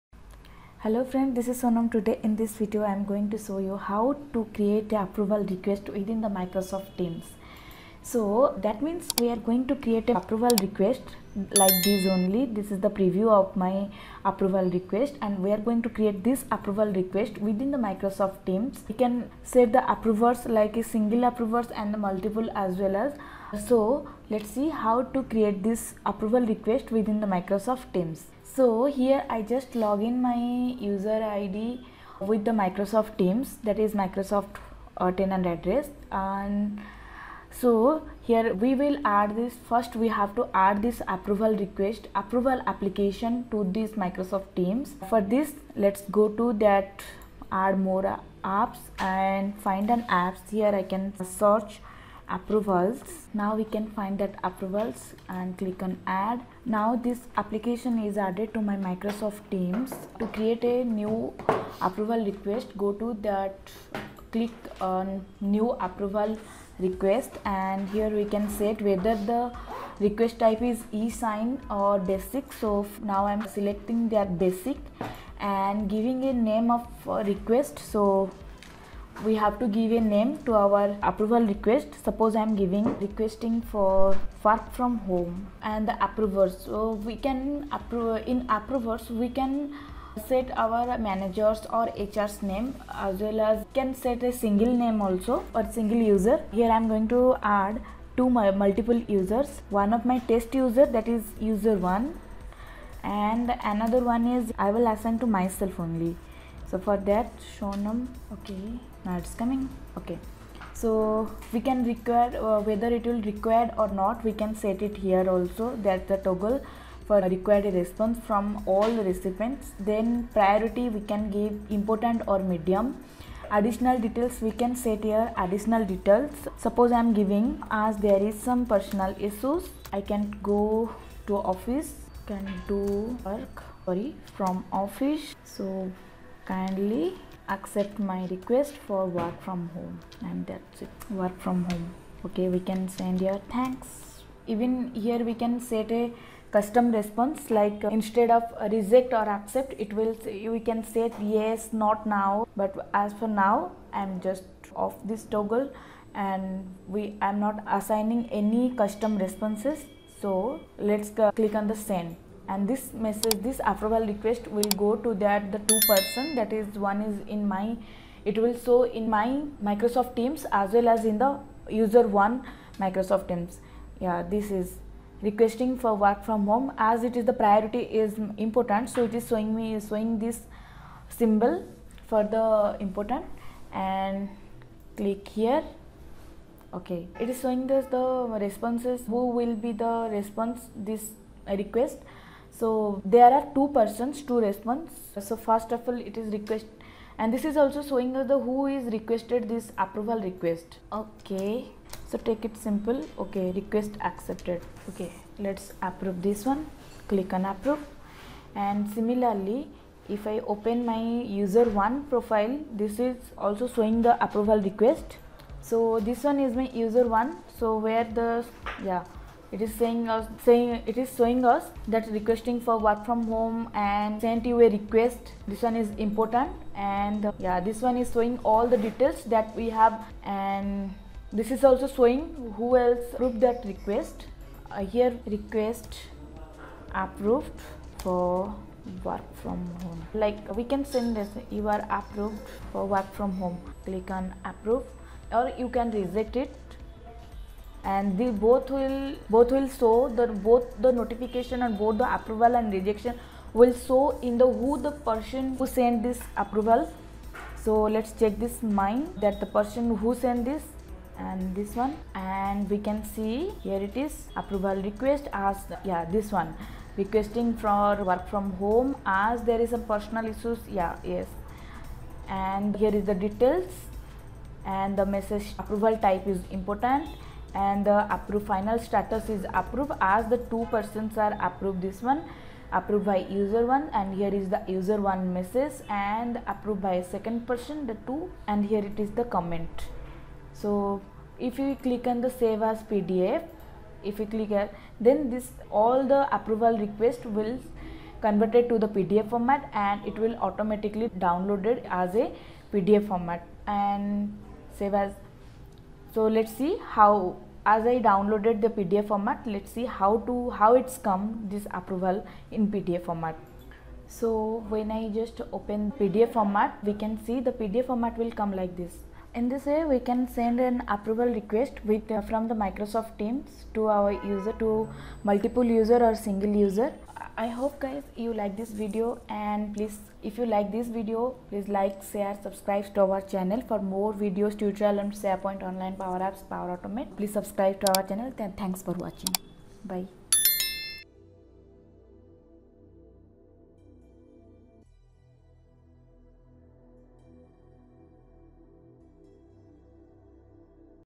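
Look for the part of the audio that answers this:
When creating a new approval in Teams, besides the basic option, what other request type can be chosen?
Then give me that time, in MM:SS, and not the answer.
01:11.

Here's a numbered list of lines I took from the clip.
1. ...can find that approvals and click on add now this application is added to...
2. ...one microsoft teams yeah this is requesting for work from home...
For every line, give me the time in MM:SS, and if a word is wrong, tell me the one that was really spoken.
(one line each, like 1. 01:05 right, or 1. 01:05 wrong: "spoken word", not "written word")
1. 00:53 right
2. 02:52 right.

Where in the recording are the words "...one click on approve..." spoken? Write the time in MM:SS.
03:26.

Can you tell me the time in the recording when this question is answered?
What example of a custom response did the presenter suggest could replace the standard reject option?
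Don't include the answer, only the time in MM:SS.
02:31.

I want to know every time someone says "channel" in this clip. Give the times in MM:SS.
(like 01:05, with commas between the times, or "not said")
05:33, 05:38.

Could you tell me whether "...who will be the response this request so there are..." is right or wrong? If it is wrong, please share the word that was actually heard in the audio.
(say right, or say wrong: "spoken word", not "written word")
right.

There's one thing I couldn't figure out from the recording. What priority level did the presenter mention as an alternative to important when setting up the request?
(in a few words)
Medium.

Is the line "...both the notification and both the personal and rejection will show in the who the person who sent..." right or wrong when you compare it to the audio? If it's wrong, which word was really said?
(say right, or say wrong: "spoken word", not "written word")
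wrong: "approval", not "personal".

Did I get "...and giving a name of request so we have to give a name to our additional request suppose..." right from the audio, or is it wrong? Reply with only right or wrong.
wrong.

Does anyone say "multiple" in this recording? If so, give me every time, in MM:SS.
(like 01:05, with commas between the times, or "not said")
00:22, 01:38, 05:25.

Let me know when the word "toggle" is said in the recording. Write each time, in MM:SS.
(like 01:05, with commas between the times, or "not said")
01:56, 02:35.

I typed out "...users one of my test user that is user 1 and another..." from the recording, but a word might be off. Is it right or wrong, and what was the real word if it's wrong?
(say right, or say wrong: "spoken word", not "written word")
right.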